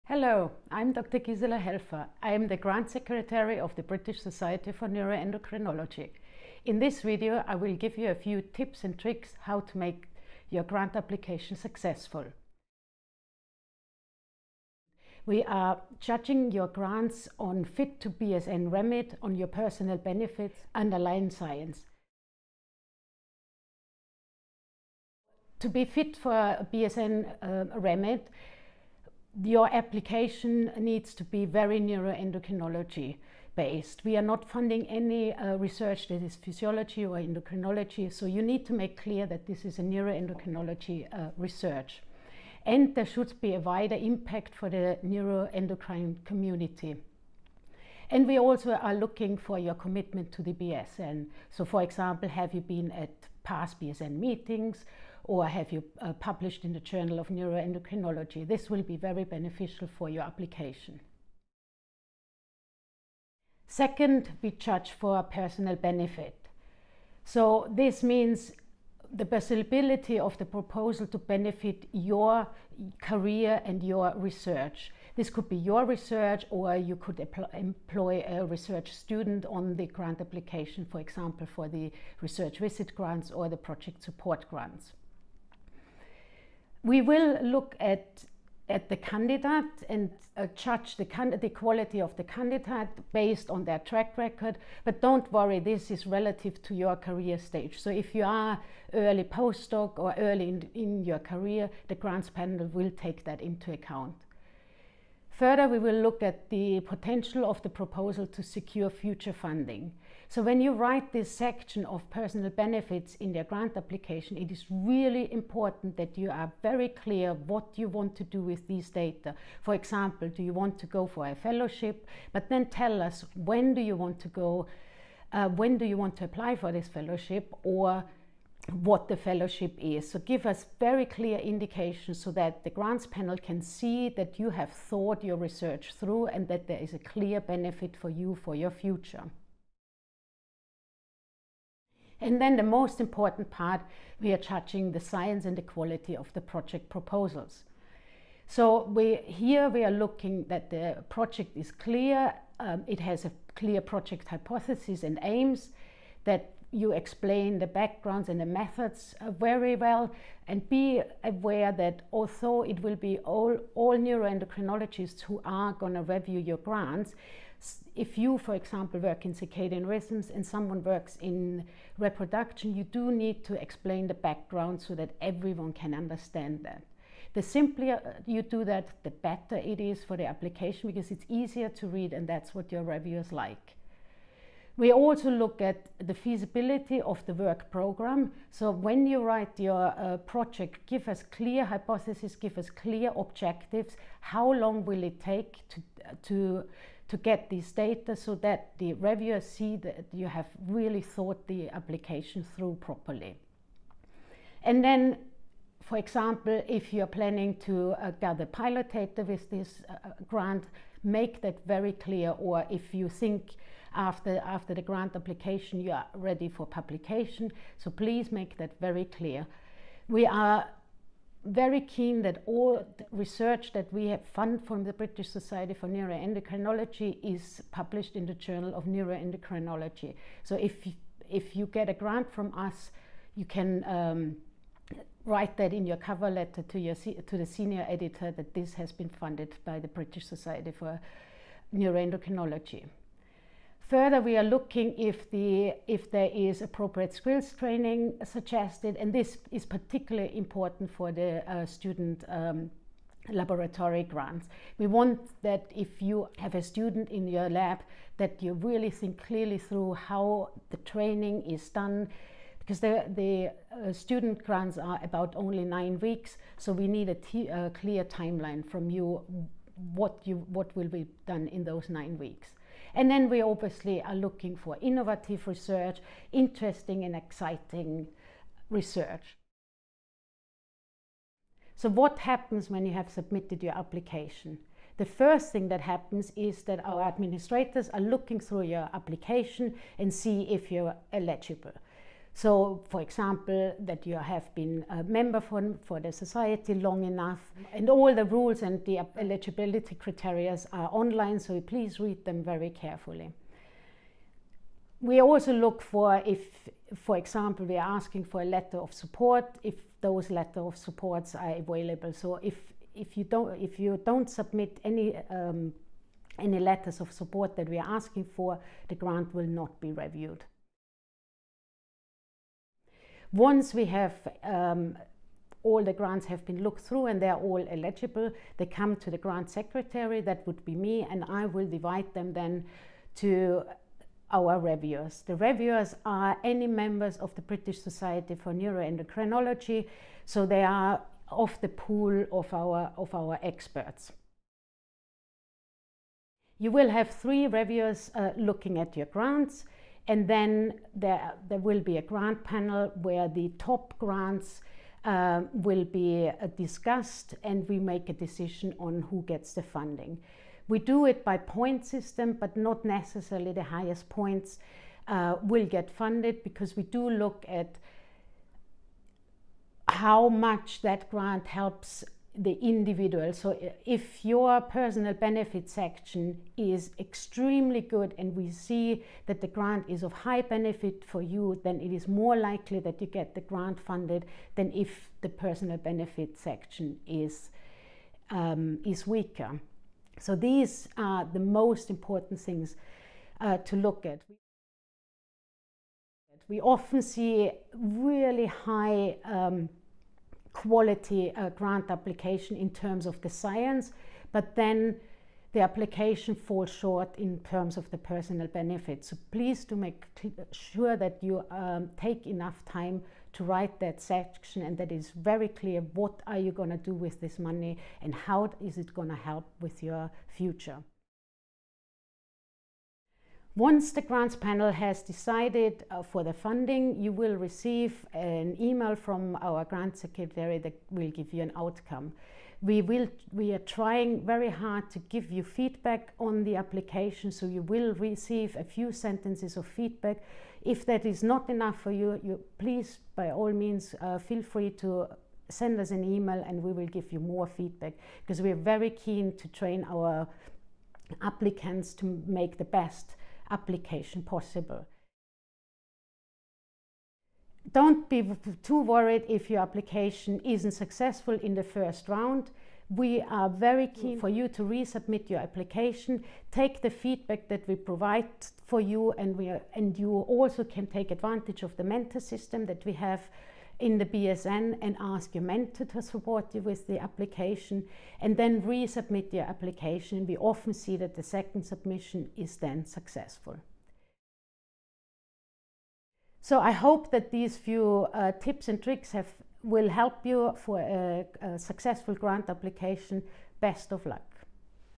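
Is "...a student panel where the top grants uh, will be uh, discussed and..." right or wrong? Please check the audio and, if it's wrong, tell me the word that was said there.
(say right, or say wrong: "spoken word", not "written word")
wrong: "grant", not "student".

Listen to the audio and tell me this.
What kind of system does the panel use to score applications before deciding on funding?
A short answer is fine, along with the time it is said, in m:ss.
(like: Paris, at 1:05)
point system, at 6:01.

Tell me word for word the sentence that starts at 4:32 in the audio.
And then we obviously are looking for innovative research, interesting and exciting research.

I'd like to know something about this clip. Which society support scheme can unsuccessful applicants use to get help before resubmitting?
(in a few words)
mentor system.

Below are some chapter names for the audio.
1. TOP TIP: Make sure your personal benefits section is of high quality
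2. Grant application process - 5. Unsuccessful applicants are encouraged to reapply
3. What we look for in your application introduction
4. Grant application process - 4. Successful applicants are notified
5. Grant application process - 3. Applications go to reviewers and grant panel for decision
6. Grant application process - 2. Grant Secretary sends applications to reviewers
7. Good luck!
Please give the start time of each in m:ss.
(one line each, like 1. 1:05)
1. 6:34
2. 7:35
3. 0:13
4. 7:01
5. 5:45
6. 5:21
7. 8:04.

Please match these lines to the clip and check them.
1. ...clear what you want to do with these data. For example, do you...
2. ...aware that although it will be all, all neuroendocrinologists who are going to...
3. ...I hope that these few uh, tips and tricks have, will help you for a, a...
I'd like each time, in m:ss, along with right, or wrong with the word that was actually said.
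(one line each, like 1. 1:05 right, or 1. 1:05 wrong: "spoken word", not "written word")
1. 1:56 right
2. 2:41 right
3. 8:06 right.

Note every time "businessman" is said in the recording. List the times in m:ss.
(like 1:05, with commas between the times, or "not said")
not said.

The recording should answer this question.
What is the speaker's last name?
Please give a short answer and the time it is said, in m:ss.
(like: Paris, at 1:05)
Helfer, at 0:01.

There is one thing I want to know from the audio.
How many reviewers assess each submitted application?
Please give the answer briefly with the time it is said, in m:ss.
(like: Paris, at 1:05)
3, at 5:47.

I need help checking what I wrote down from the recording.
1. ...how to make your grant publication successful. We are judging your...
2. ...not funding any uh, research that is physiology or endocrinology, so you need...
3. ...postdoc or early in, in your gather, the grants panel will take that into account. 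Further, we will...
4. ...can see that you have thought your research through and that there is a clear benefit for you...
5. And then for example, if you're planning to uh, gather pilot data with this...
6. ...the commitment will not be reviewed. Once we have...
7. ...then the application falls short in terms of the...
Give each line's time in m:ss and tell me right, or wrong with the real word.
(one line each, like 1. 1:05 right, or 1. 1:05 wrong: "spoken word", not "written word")
1. 0:09 wrong: "application", not "publication"
2. 0:34 right
3. 1:39 wrong: "career", not "gather"
4. 2:13 right
5. 3:24 right
6. 5:18 wrong: "grant", not "commitment"
7. 6:44 right.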